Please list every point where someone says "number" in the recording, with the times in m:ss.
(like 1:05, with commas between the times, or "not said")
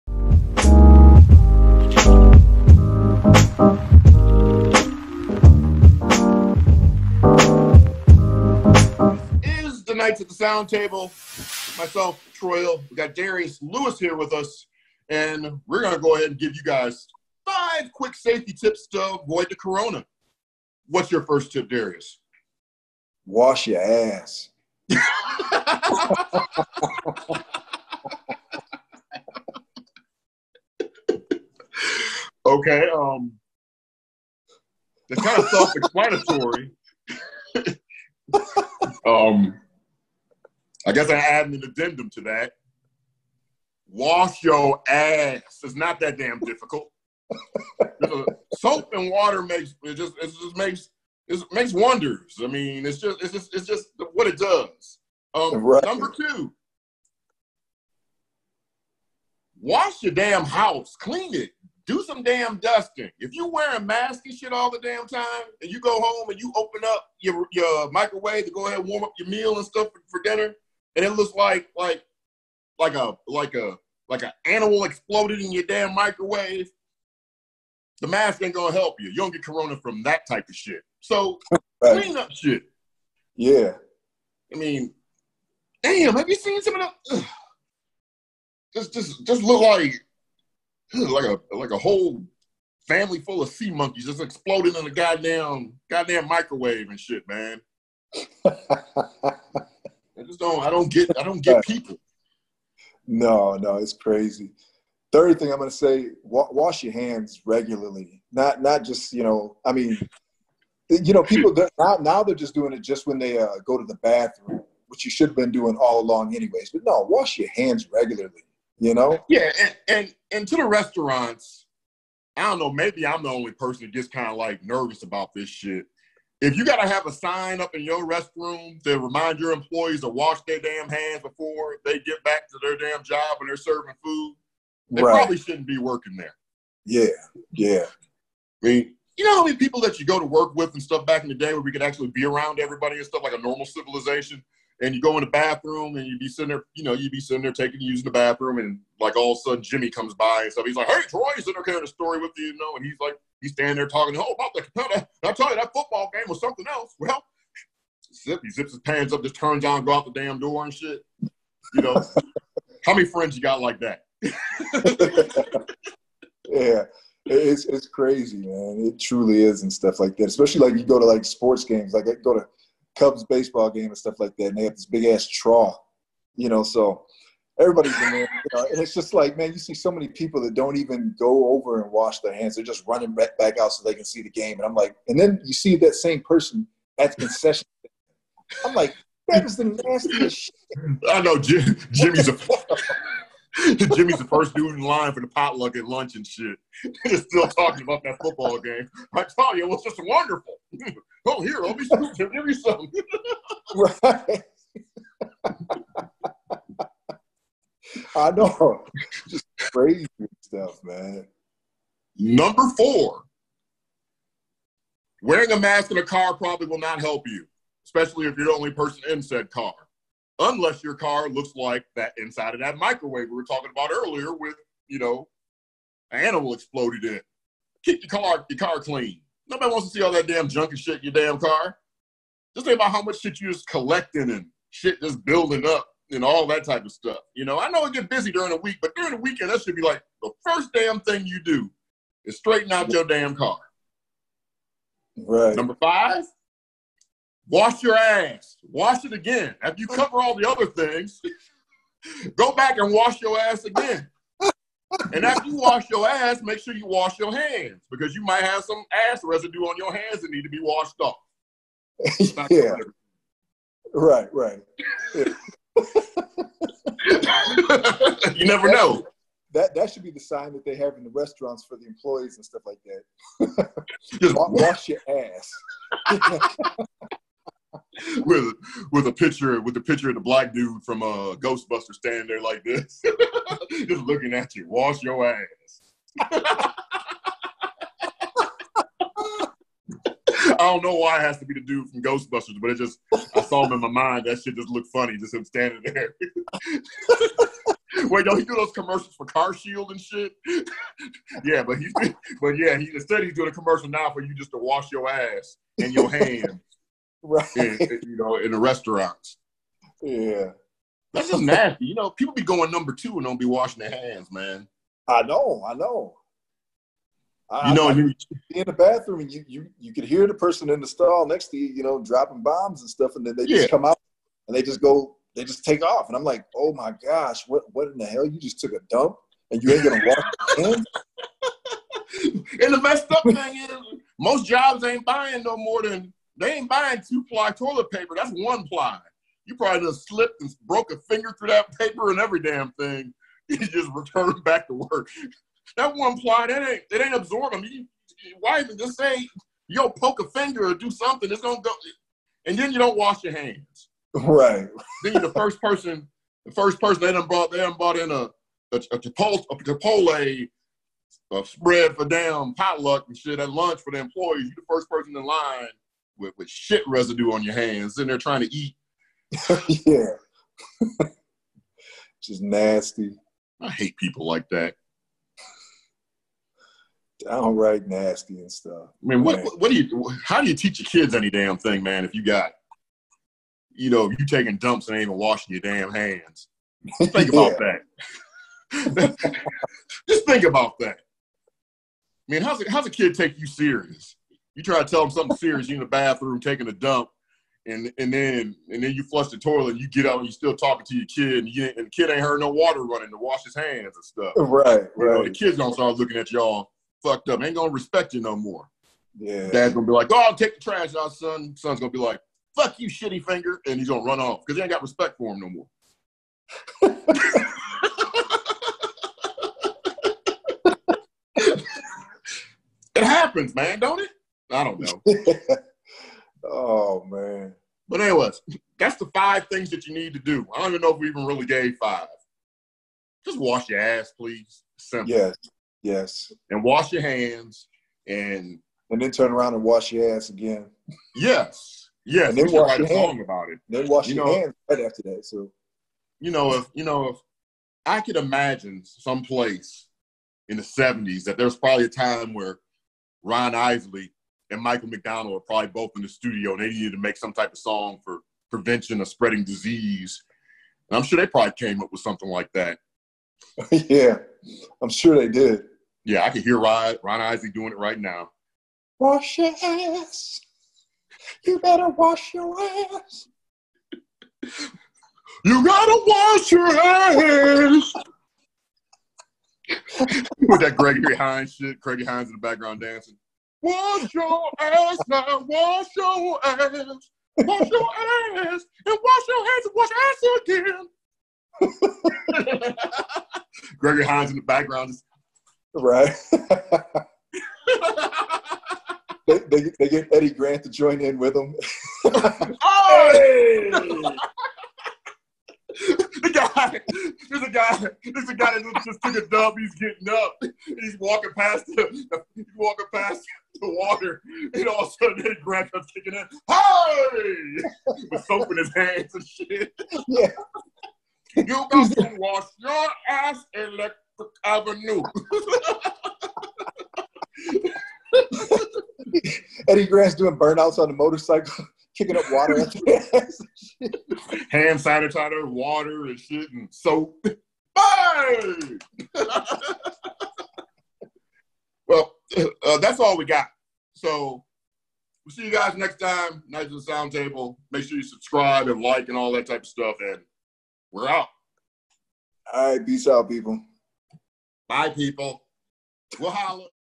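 0:55, 3:32, 4:05, 5:12.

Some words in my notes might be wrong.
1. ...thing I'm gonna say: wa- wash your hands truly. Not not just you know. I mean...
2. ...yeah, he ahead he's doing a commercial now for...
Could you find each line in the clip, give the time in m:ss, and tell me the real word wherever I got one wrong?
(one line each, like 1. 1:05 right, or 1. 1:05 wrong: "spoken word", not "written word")
1. 1:45 wrong: "regularly", not "truly"
2. 5:02 wrong: "instead", not "ahead".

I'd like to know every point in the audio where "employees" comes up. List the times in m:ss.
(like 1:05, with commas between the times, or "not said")
2:09, 4:31, 6:03.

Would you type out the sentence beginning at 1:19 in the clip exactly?
You don't get corona from that type of shit.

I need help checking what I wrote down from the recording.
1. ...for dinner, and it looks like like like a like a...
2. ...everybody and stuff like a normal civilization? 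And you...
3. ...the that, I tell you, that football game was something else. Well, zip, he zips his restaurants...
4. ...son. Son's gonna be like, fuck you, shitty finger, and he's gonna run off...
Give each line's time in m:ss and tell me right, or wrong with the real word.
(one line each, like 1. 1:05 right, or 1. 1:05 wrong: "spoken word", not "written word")
1. 1:10 right
2. 2:22 right
3. 2:34 wrong: "pants", not "restaurants"
4. 6:51 right.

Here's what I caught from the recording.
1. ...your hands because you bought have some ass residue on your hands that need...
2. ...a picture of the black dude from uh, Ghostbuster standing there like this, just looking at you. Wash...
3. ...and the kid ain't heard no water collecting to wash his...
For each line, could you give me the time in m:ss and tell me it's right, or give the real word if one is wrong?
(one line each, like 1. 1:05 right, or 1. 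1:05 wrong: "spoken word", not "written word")
1. 4:17 wrong: "might", not "bought"
2. 4:39 right
3. 6:41 wrong: "running", not "collecting".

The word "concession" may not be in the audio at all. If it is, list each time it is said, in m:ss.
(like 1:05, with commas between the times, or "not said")
3:07.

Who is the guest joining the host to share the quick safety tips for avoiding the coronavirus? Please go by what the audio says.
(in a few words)
Darius Lewis.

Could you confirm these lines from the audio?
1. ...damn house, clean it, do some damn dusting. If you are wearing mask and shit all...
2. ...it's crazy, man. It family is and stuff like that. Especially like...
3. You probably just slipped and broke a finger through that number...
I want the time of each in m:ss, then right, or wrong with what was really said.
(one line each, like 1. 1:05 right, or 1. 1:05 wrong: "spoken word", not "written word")
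1. 1:00 right
2. 2:47 wrong: "truly", not "family"
3. 5:39 wrong: "paper", not "number".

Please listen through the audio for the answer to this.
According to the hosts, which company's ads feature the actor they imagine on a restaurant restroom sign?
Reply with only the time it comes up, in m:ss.
4:59.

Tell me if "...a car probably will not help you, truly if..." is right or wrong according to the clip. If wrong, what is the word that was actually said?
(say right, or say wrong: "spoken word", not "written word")
wrong: "especially", not "truly".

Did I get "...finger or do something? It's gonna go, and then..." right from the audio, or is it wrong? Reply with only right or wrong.
right.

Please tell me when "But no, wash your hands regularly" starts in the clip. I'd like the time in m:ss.
1:56.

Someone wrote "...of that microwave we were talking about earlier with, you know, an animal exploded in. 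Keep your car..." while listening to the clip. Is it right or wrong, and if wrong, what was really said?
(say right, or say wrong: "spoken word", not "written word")
right.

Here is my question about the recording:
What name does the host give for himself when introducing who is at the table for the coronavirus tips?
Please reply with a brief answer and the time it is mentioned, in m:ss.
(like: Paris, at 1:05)
Troyal, at 0:12.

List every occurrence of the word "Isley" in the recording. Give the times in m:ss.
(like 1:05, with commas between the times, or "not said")
7:33, 7:47.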